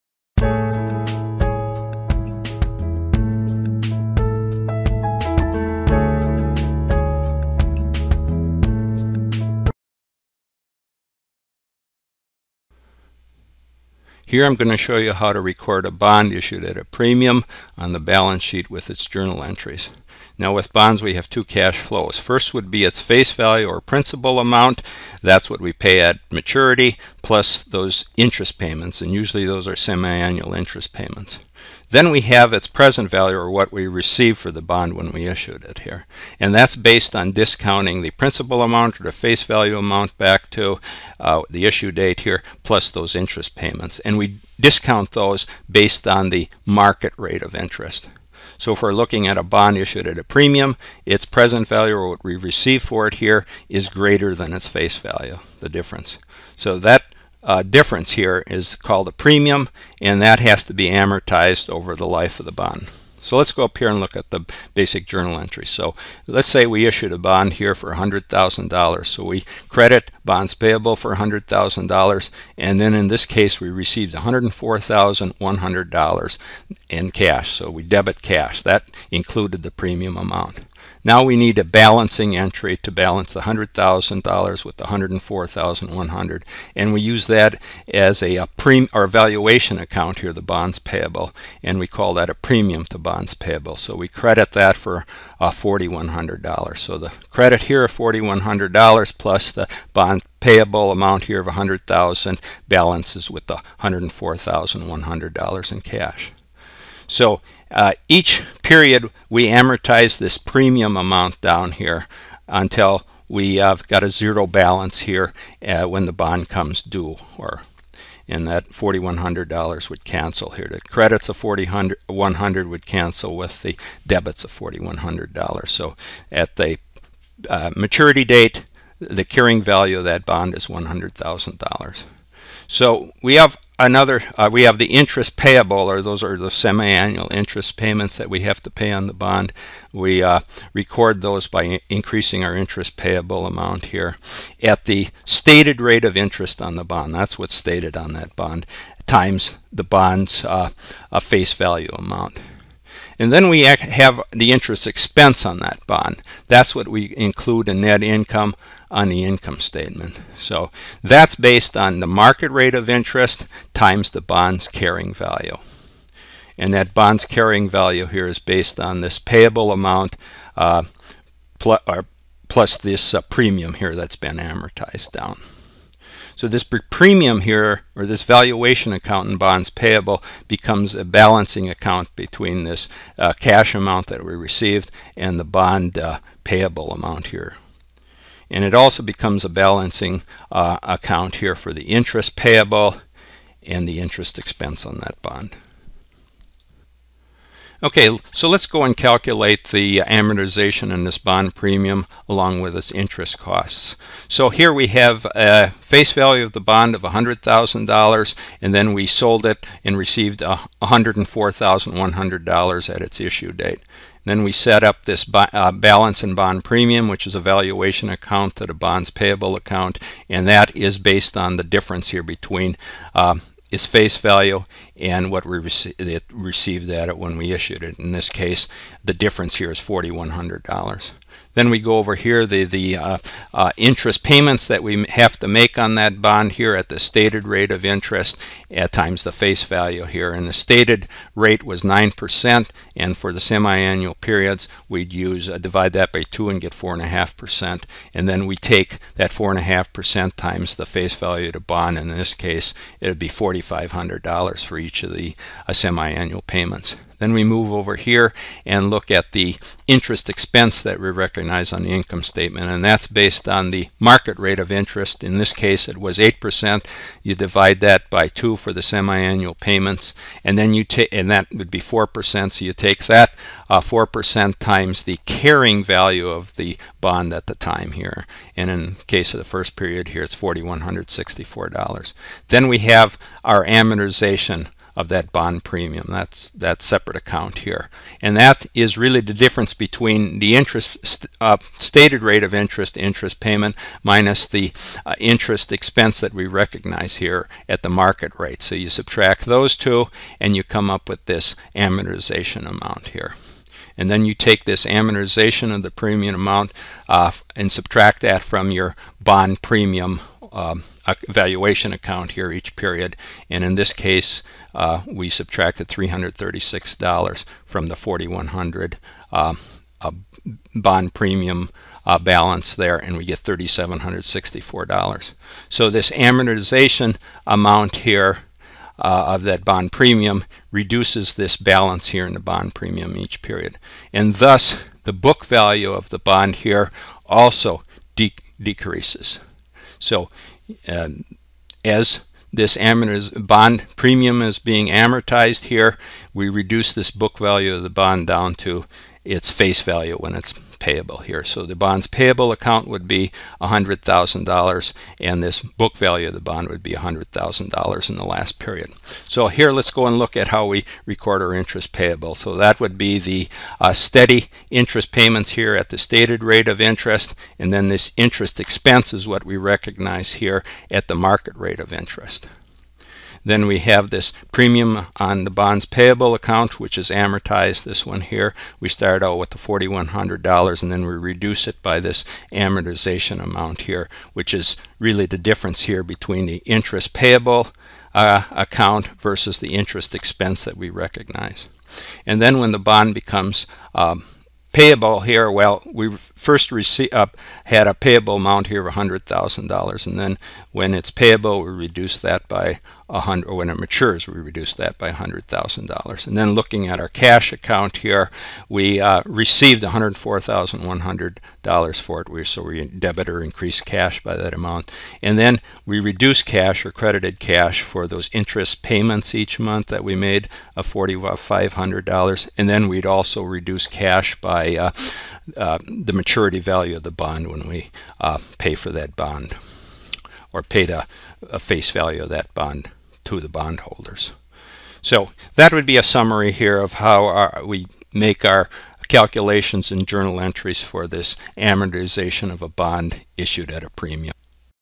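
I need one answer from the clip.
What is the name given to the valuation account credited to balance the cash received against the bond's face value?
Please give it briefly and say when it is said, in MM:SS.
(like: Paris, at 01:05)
premium to bonds payable, at 01:32.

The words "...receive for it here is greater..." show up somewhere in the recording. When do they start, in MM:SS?
00:52.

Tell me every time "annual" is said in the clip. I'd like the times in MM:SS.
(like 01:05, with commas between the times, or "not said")
00:29, 02:16, 04:03, 04:15, 04:28.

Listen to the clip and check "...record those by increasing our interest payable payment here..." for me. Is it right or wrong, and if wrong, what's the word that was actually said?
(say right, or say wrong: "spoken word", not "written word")
wrong: "amount", not "payment".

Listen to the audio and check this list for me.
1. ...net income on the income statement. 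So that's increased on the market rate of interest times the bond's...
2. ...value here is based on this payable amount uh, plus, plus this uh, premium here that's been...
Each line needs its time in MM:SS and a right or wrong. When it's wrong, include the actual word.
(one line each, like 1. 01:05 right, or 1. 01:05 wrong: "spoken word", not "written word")
1. 02:37 wrong: "based", not "increased"
2. 02:47 right.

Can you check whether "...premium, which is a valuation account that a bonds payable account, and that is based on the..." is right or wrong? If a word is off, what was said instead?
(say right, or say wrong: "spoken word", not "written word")
right.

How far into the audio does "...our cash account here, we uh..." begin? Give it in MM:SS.
06:47.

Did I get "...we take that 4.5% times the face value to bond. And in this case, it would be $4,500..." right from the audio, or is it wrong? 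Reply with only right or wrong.
right.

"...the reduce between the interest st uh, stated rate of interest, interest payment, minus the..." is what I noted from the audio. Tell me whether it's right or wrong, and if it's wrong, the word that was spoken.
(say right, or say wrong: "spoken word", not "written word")
wrong: "difference", not "reduce".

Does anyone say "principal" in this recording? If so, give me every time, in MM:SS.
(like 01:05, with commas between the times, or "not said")
00:23, 00:38.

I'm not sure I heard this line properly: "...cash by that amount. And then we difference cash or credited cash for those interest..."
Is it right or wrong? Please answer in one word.
wrong.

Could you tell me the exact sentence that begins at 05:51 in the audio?
So the bond's payable account would be $100,000 and this book value of the bond would be $100,000 in the last period.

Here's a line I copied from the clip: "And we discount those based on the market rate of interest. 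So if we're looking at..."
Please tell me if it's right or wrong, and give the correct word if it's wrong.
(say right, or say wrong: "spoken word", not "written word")
right.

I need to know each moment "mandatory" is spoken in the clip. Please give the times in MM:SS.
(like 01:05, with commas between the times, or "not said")
not said.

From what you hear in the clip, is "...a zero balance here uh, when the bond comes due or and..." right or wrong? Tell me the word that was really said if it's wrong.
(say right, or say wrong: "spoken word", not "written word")
right.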